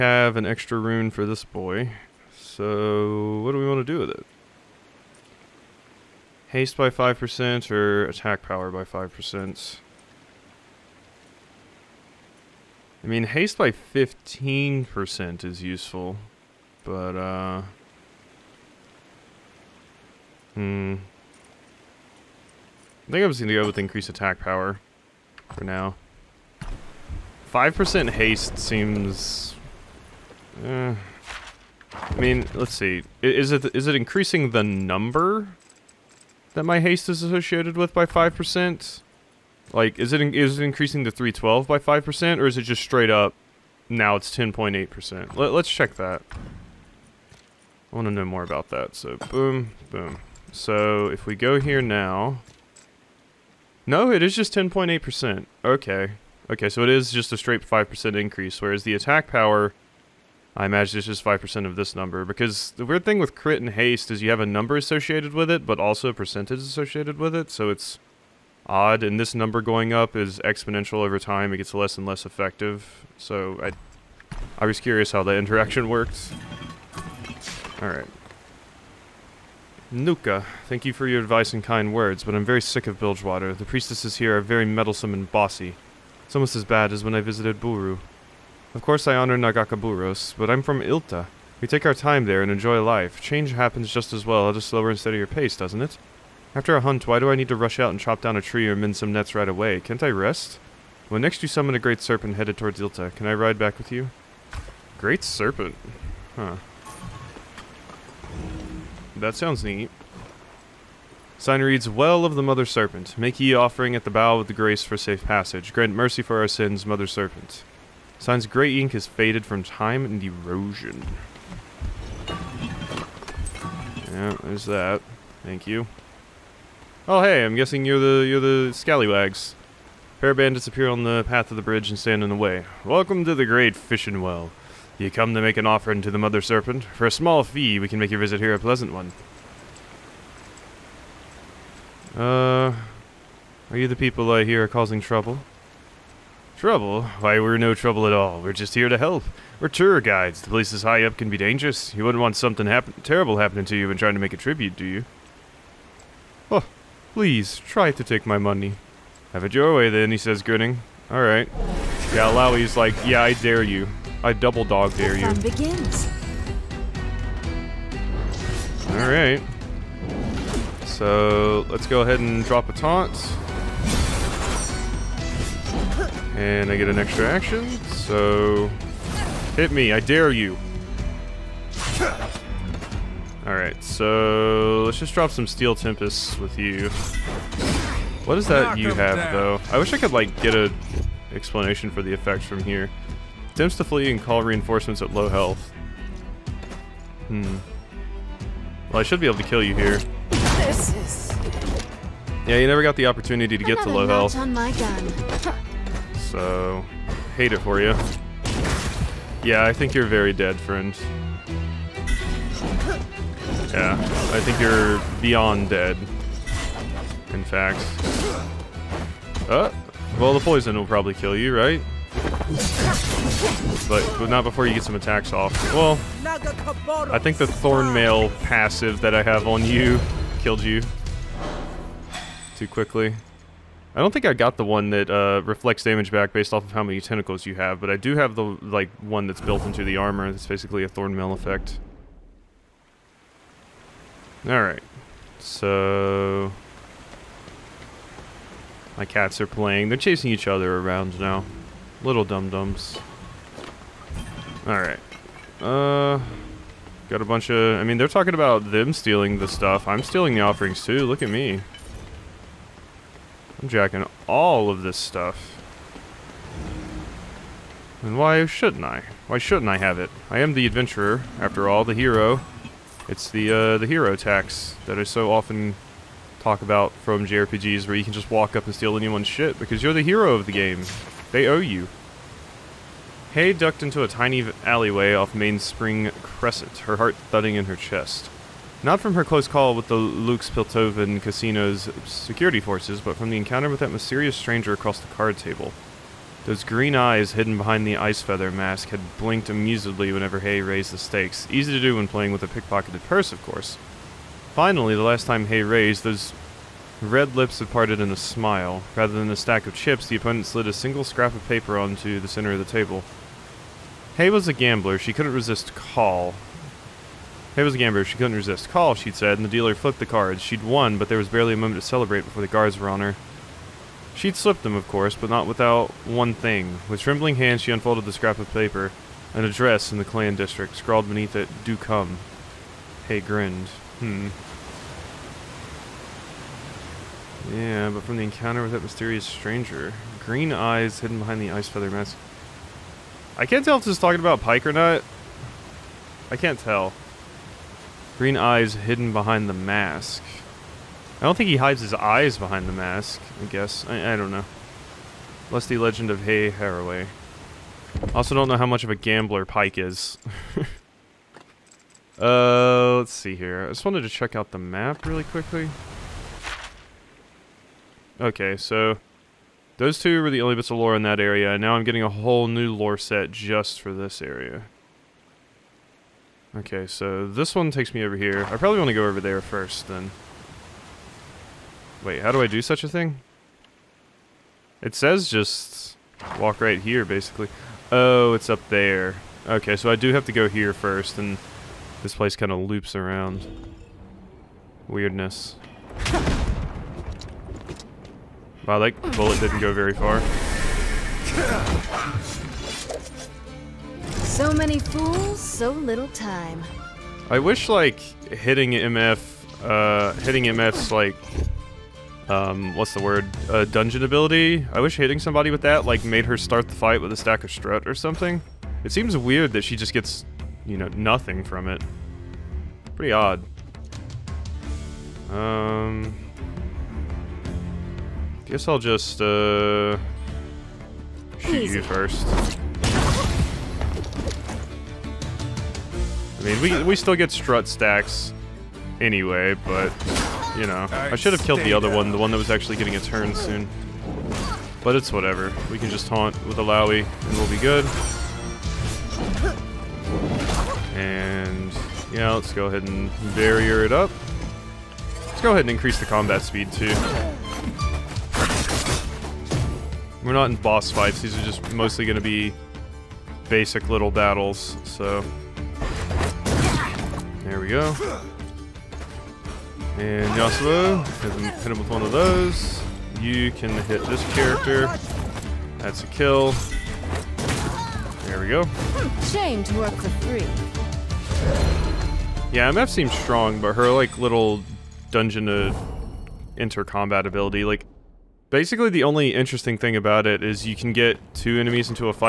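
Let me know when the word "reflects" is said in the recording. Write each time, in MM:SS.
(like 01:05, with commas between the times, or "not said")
03:55.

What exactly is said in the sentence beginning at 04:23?
I'm jacking all of this stuff.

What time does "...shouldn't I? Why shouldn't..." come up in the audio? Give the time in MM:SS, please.
04:28.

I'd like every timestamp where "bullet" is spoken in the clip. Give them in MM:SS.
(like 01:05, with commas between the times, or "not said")
06:39.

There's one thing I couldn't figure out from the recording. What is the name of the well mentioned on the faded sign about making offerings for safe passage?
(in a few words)
Well of the Mother Serpent.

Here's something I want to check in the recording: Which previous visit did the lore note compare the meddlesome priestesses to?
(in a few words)
Buhru.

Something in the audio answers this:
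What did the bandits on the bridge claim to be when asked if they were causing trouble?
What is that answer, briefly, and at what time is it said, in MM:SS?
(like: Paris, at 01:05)
Tour guides, at 02:29.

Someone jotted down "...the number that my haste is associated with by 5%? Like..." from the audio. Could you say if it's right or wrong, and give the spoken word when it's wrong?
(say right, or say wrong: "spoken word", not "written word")
right.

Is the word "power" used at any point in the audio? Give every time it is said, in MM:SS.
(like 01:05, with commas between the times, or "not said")
00:08, 00:24, 00:59.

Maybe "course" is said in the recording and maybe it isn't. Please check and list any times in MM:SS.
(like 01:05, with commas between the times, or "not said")
01:28, 05:03, 05:24.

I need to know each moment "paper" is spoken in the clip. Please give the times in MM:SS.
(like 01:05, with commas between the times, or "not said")
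05:11, 05:28.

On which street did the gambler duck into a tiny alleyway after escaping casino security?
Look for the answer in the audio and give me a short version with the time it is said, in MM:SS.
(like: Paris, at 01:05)
Mainspring Crescent, at 04:45.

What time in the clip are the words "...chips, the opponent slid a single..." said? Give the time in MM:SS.
05:09.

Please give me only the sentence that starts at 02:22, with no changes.
Uh, are you the people I hear are causing trouble?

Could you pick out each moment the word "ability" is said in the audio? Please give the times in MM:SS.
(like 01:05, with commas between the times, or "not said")
06:54, 08:07.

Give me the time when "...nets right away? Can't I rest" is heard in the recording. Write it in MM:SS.
01:39.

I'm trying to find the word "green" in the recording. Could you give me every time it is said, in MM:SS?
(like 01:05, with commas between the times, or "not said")
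04:56, 05:40, 05:48.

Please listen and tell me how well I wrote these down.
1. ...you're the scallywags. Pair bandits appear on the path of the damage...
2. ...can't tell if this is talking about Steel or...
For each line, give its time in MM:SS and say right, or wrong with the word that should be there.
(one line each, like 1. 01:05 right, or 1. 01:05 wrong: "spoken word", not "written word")
1. 02:08 wrong: "bridge", not "damage"
2. 05:43 wrong: "Pyke", not "Steel".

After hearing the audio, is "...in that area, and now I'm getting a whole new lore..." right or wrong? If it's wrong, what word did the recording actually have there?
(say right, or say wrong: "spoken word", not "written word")
right.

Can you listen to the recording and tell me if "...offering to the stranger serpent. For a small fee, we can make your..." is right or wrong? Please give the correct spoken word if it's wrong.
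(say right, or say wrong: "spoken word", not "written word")
wrong: "mother", not "stranger".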